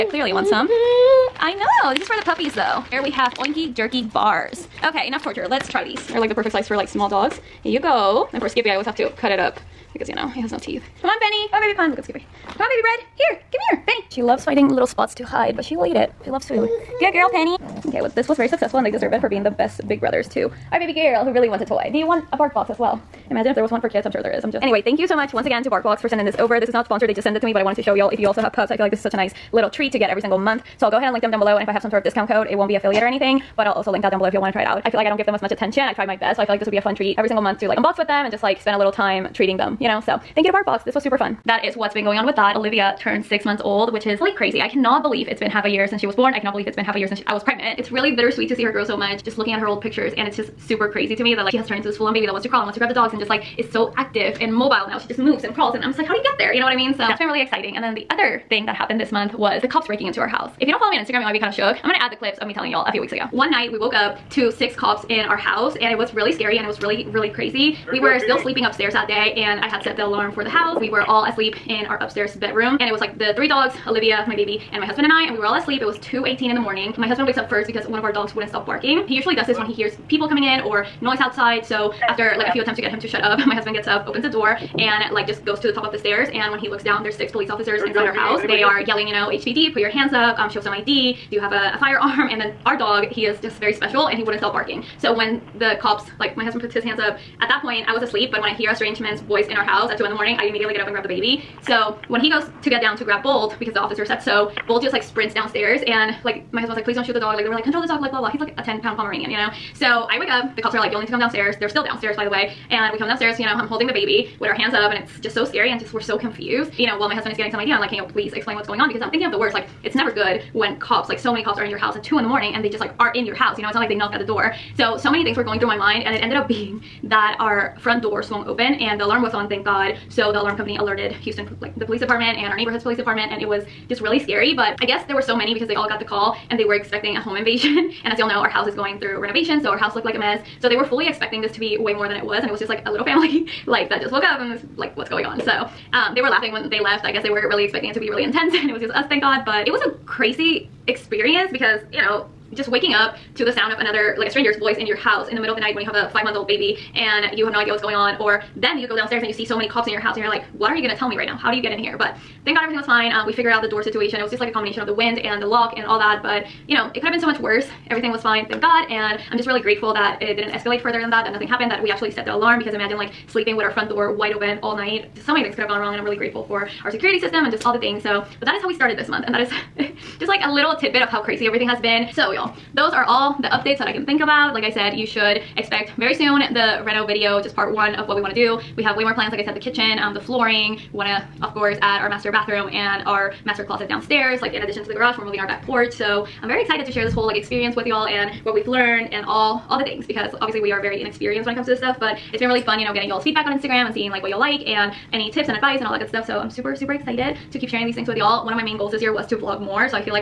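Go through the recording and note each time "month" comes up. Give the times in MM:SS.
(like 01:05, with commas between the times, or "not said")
00:30, 00:37, 00:43, 00:59, 02:36, 02:59.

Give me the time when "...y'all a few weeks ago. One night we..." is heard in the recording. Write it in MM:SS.
01:02.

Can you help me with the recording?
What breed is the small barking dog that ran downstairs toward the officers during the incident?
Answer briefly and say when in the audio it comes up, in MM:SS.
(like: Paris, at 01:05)
Pomeranian, at 01:48.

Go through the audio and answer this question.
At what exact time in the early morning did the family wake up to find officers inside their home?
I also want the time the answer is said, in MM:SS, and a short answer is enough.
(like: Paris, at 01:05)
2:18, at 01:16.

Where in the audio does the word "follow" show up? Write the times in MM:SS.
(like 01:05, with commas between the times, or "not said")
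01:00.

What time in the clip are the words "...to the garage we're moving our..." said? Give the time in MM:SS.
03:14.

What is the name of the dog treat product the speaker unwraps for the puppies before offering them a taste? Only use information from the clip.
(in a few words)
Oinky Jerky Bars.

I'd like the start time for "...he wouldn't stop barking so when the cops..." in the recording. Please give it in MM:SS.
01:34.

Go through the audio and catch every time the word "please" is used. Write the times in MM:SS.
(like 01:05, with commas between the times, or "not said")
01:46, 01:58.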